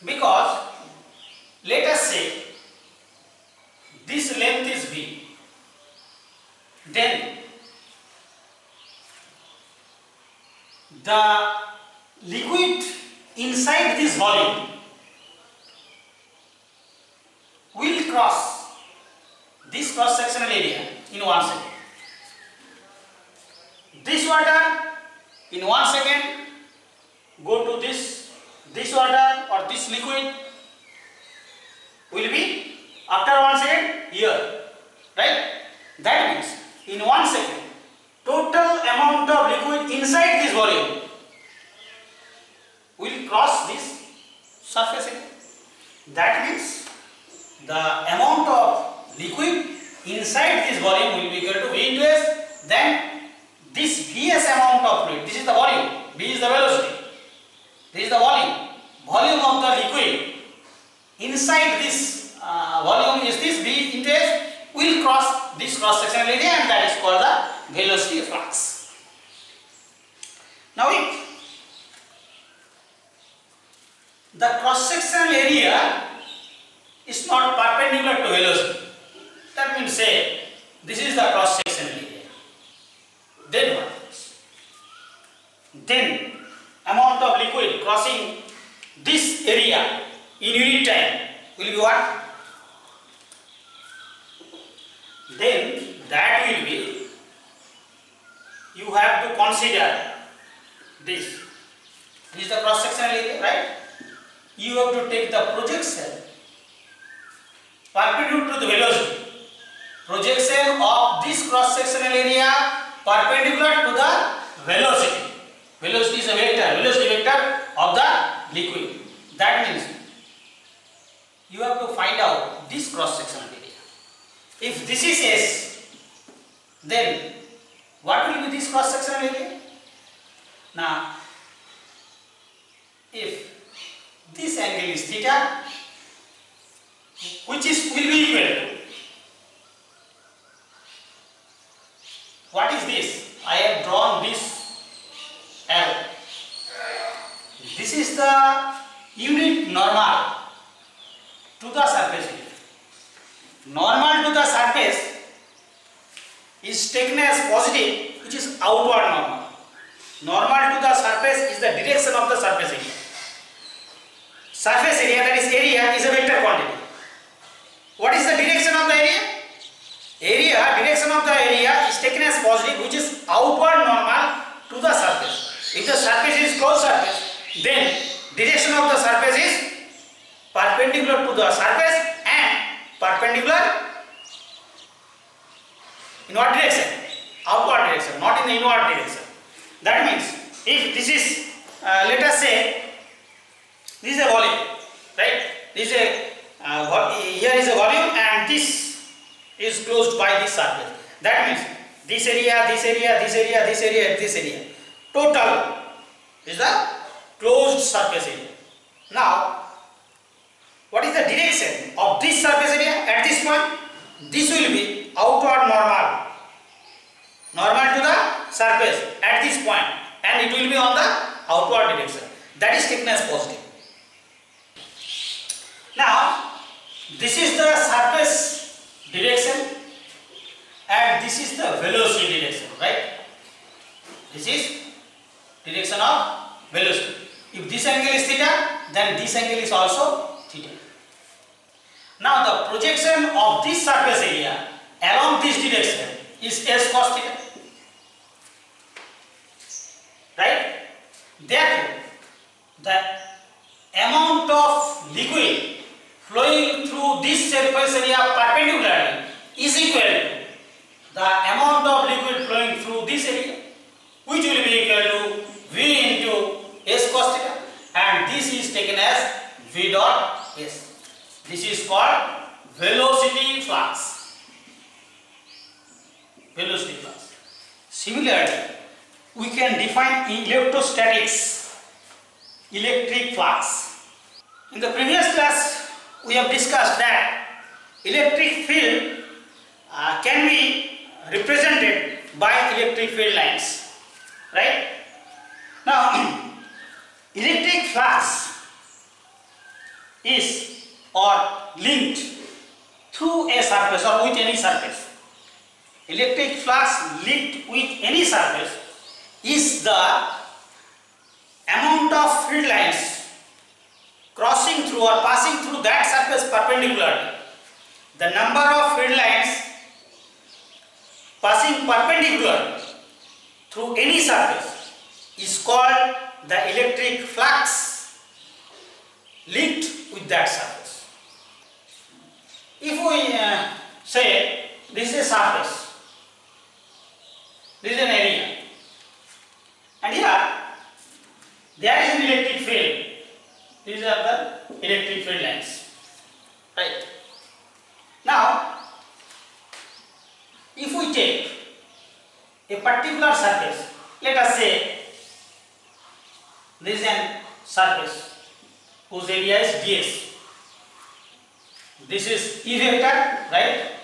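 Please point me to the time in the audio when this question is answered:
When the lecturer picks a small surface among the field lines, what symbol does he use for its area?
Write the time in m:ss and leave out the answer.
5:59.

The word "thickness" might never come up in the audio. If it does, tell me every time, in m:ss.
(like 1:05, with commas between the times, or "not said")
3:42.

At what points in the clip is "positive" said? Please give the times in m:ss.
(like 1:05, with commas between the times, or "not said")
2:52, 3:43.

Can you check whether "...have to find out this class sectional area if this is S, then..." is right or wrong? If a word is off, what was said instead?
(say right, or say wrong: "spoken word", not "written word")
wrong: "cross", not "class".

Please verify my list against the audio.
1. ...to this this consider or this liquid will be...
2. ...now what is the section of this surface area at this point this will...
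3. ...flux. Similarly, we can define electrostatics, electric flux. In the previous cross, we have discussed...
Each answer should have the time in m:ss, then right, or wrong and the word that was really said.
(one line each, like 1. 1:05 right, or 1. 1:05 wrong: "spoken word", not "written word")
1. 0:27 wrong: "water", not "consider"
2. 3:29 wrong: "direction", not "section"
3. 4:37 wrong: "class", not "cross".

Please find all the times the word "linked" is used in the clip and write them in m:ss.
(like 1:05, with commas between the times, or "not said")
5:01, 5:07, 5:29.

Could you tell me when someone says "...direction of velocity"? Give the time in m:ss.
3:55.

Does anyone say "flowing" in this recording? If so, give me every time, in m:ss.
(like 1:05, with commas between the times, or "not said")
4:16, 4:22.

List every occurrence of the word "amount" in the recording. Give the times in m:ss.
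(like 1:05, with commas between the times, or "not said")
0:38, 0:48, 0:54, 1:26, 4:13, 4:21, 5:11.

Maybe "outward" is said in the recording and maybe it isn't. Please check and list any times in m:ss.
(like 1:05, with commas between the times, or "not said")
2:53, 3:07, 3:35, 3:41.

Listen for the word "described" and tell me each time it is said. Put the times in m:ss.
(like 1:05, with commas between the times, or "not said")
not said.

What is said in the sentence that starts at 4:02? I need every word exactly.
Now the projection of this surface area along this direction is S cos theta.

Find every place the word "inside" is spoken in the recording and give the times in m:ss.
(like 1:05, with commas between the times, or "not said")
0:13, 0:39, 0:50, 1:01.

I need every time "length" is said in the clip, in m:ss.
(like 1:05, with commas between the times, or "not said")
0:04.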